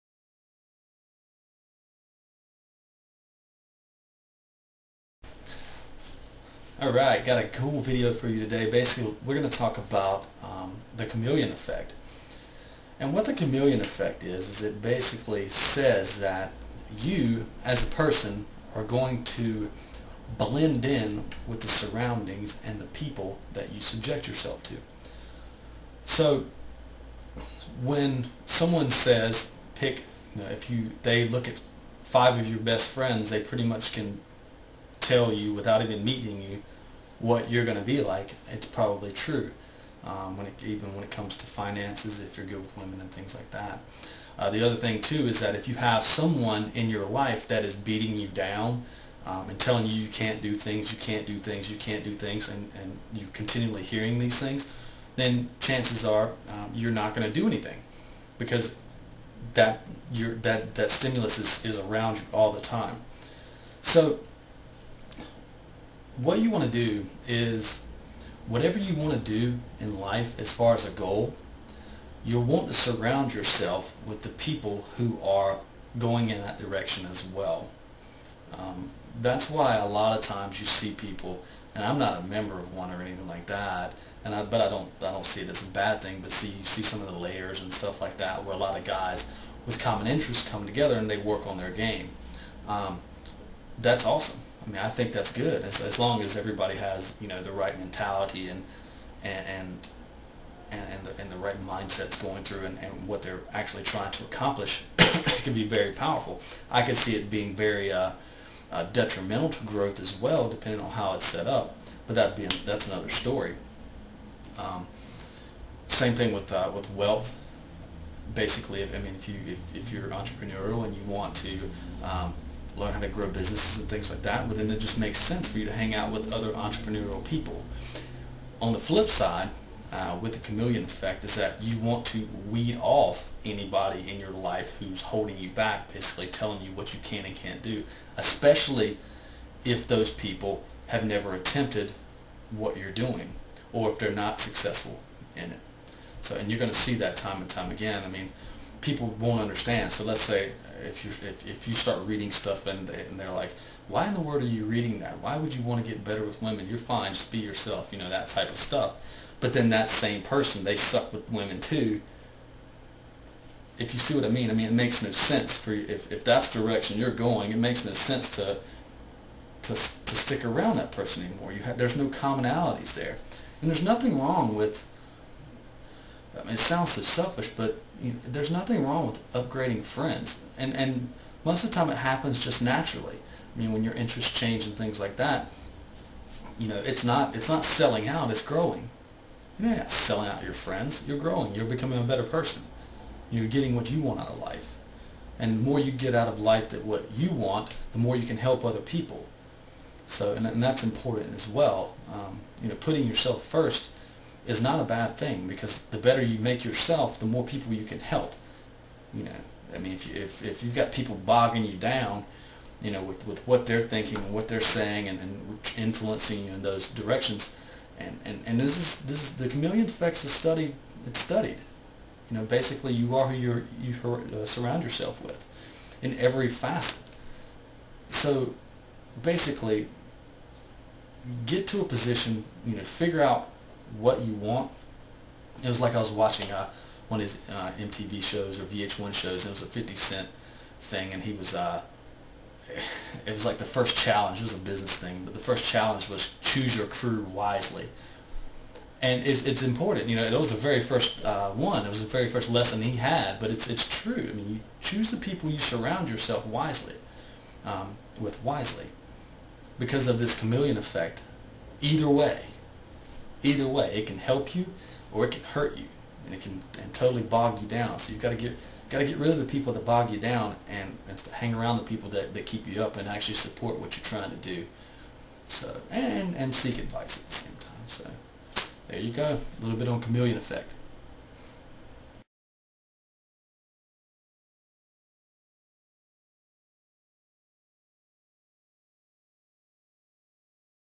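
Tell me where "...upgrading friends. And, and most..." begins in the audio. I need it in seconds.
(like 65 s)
179 s.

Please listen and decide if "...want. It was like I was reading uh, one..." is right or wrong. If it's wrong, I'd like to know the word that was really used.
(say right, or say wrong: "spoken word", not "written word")
wrong: "watching", not "reading".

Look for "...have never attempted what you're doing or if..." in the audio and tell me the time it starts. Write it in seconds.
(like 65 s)
140 s.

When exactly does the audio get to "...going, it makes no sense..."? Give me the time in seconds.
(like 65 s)
167 s.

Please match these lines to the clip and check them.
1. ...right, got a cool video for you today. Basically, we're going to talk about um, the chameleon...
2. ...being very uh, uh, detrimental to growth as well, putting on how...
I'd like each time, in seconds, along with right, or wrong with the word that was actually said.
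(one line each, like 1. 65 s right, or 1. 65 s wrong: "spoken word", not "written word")
1. 6 s right
2. 107 s wrong: "depending", not "putting".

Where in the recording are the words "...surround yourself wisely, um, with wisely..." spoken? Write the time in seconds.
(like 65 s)
255 s.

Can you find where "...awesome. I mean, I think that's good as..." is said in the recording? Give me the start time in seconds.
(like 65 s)
94 s.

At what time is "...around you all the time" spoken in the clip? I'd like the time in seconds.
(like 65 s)
61 s.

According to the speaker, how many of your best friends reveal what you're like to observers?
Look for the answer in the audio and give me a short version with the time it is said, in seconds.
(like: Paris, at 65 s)
5, at 31 s.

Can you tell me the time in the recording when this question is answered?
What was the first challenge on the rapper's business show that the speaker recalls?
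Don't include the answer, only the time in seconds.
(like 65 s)
246 s.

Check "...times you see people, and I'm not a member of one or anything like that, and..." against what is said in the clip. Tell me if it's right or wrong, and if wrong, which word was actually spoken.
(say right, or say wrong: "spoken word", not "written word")
right.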